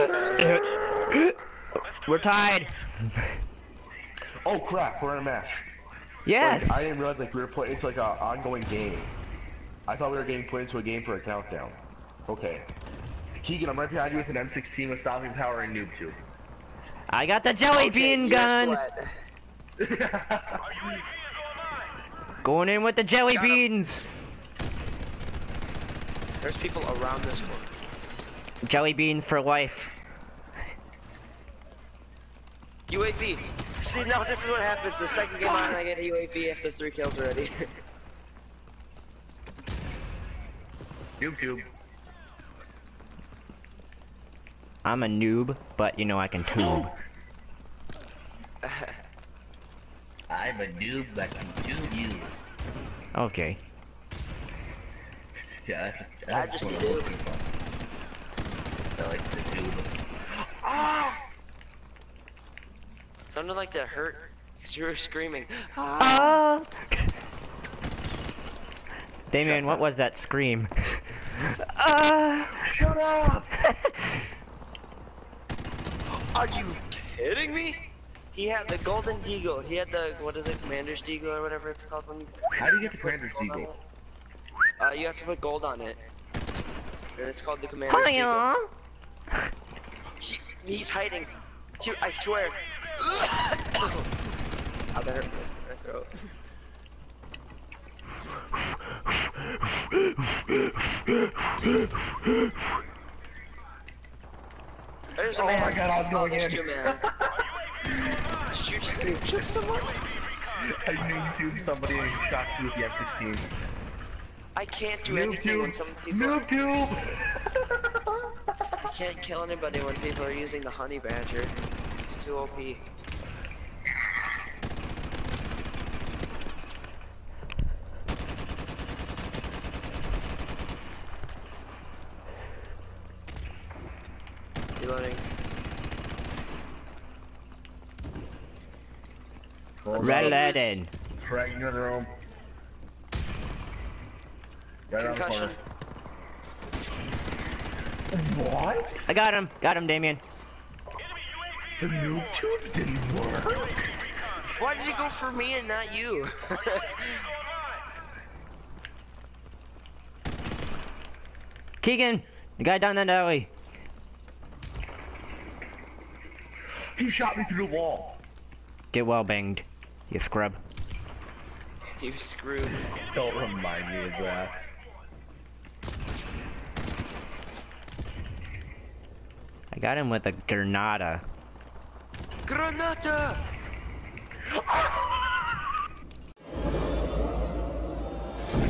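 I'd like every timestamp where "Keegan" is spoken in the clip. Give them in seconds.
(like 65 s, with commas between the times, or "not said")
13 s, 161 s.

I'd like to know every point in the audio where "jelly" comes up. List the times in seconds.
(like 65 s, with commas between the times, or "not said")
17 s, 23 s, 28 s.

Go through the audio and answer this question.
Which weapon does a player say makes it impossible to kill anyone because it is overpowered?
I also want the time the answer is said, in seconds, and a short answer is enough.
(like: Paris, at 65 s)
Honey badger, at 120 s.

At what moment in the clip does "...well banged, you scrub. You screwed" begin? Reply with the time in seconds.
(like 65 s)
169 s.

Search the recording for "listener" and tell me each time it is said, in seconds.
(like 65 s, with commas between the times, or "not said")
not said.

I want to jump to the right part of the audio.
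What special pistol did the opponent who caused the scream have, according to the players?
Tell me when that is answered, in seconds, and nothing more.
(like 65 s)
78 s.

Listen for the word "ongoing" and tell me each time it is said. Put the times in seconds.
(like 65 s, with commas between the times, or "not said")
8 s.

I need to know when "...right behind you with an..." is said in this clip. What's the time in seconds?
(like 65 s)
13 s.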